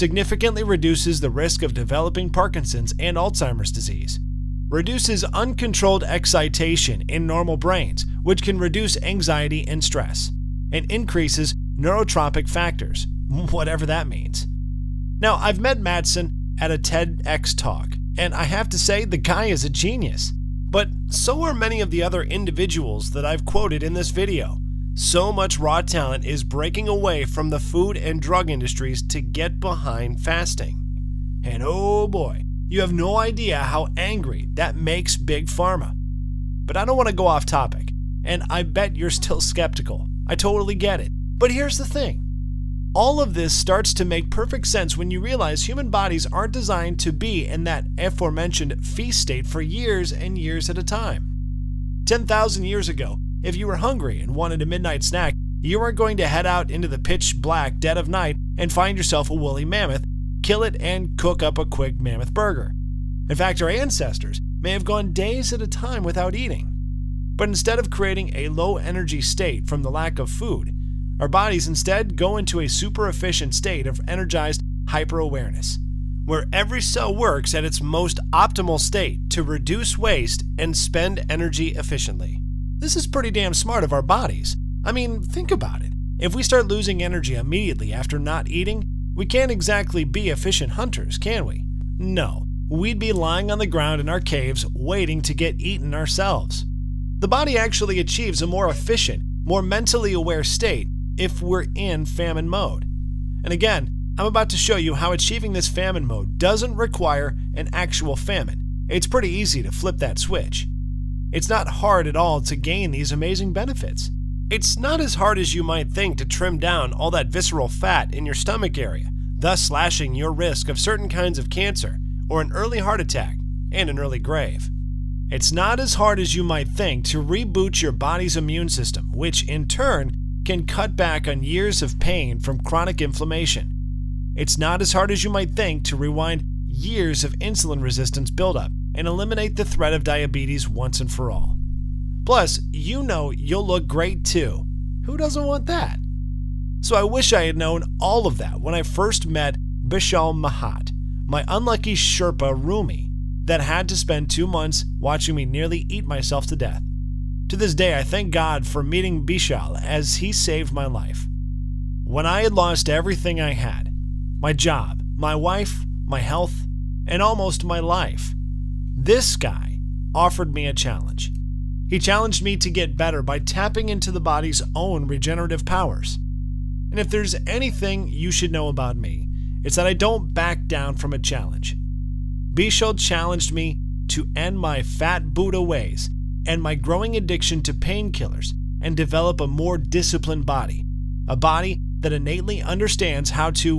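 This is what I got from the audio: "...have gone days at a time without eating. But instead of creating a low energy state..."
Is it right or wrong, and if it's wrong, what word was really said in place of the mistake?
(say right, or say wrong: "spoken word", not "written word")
right.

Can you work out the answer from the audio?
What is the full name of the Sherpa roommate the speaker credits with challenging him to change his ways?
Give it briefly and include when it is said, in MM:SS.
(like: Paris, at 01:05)
Bishal Mahat, at 02:29.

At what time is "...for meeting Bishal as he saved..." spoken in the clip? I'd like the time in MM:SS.
02:38.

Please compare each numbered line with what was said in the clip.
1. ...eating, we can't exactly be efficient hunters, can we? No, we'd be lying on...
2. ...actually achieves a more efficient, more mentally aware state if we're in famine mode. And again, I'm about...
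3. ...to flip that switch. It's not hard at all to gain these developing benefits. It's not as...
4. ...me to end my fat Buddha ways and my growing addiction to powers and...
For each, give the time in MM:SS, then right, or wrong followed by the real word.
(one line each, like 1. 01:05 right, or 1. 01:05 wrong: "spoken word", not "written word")
1. 01:28 right
2. 01:37 right
3. 01:49 wrong: "amazing", not "developing"
4. 03:03 wrong: "painkillers", not "powers".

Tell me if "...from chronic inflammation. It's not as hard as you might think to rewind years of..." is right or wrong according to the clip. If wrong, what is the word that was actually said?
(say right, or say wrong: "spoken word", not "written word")
right.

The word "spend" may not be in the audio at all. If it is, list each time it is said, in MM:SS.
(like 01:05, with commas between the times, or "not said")
01:20, 02:33.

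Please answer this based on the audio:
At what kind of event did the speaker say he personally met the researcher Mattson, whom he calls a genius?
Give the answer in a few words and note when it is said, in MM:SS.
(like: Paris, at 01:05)
A TEDx talk, at 00:16.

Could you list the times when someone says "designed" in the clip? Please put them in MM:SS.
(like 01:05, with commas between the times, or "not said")
00:46.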